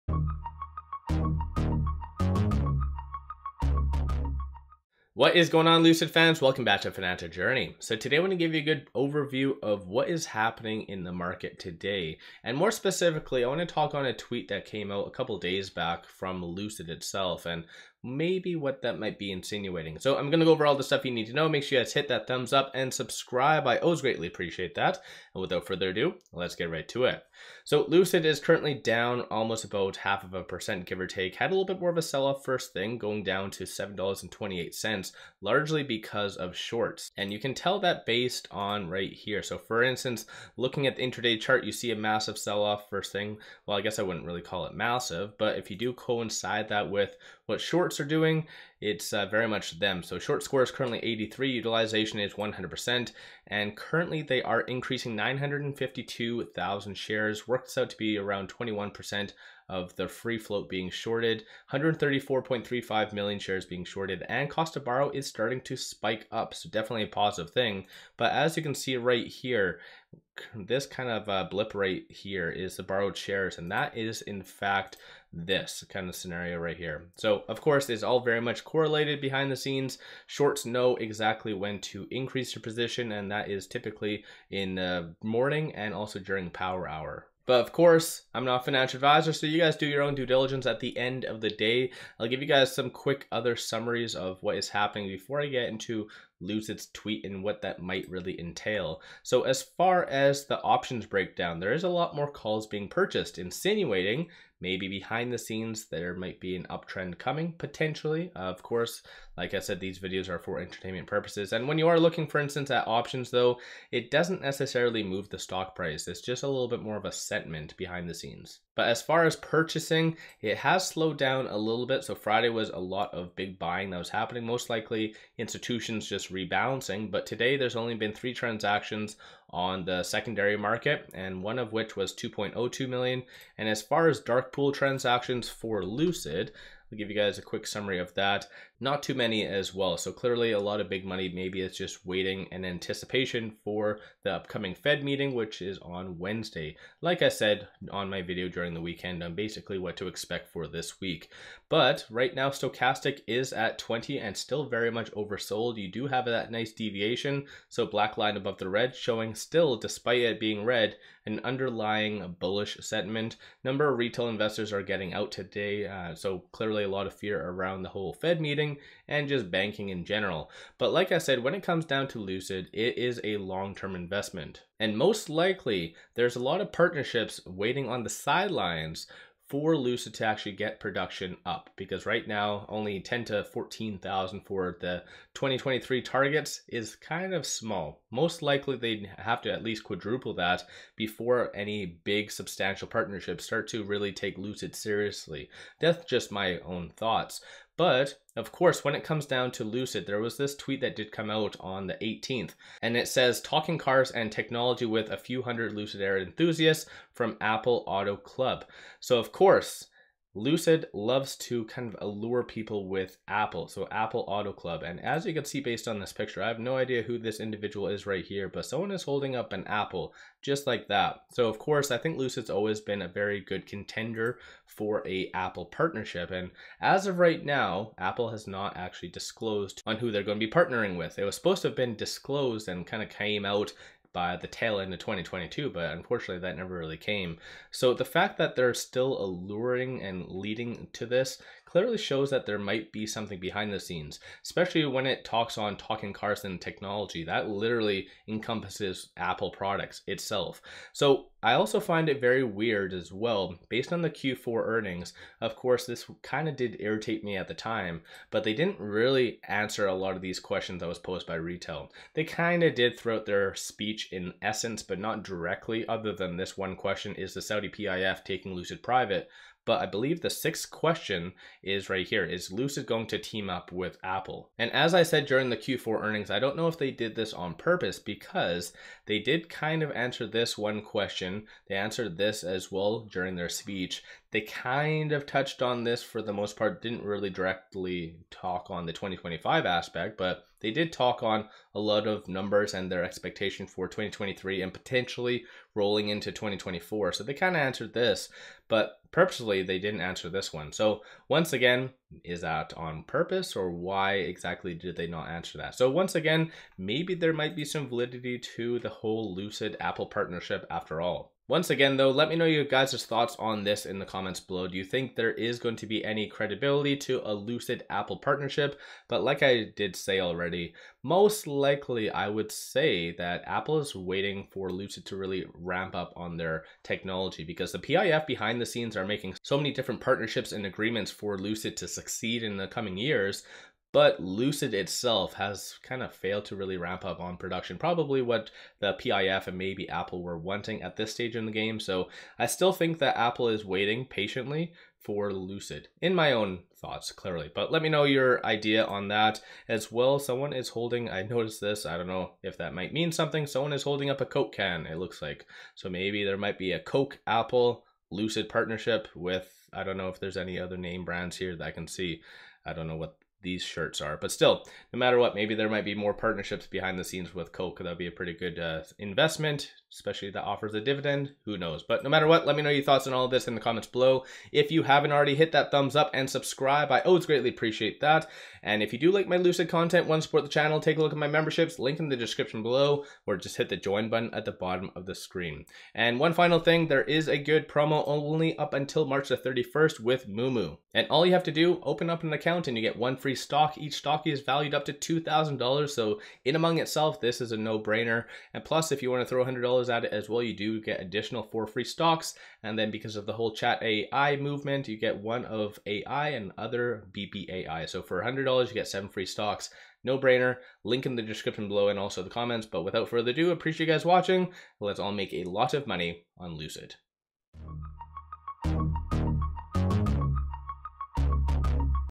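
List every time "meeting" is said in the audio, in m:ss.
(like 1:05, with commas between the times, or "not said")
2:25, 2:48.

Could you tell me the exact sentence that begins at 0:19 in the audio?
So I'm going to go over all the stuff you need to know.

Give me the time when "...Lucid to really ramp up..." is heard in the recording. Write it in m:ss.
5:24.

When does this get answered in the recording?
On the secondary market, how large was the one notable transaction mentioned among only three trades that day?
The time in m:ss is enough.
2:12.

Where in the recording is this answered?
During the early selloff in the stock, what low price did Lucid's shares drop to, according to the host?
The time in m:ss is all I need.
0:33.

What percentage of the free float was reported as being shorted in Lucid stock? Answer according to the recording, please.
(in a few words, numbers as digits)
21%.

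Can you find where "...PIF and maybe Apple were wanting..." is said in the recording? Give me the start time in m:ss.
5:38.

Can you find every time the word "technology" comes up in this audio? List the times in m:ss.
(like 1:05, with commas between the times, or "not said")
3:24, 4:06, 5:26.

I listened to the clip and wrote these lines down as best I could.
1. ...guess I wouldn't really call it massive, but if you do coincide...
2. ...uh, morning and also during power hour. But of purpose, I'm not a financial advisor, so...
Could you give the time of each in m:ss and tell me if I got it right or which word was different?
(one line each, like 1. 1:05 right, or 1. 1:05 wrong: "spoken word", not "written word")
1. 0:43 right
2. 1:25 wrong: "course", not "purpose".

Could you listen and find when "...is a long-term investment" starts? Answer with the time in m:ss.
2:52.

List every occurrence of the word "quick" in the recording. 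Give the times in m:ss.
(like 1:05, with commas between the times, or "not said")
1:32, 2:17.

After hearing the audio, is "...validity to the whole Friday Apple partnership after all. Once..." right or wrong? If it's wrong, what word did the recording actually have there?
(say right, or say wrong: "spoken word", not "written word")
wrong: "Lucid", not "Friday".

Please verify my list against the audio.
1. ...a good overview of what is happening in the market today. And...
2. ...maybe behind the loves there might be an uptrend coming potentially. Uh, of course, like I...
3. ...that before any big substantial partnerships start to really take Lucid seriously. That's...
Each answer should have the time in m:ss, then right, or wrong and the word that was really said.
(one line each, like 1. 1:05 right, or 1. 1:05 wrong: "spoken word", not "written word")
1. 0:08 right
2. 1:44 wrong: "scenes", not "loves"
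3. 3:10 right.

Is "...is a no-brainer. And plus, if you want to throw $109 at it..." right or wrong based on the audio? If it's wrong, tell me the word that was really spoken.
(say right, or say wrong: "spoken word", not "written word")
wrong: "100", not "109".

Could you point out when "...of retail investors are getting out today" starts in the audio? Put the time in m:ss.
2:43.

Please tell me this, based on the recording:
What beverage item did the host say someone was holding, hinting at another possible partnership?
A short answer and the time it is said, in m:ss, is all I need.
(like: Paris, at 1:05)
Coke can, at 5:54.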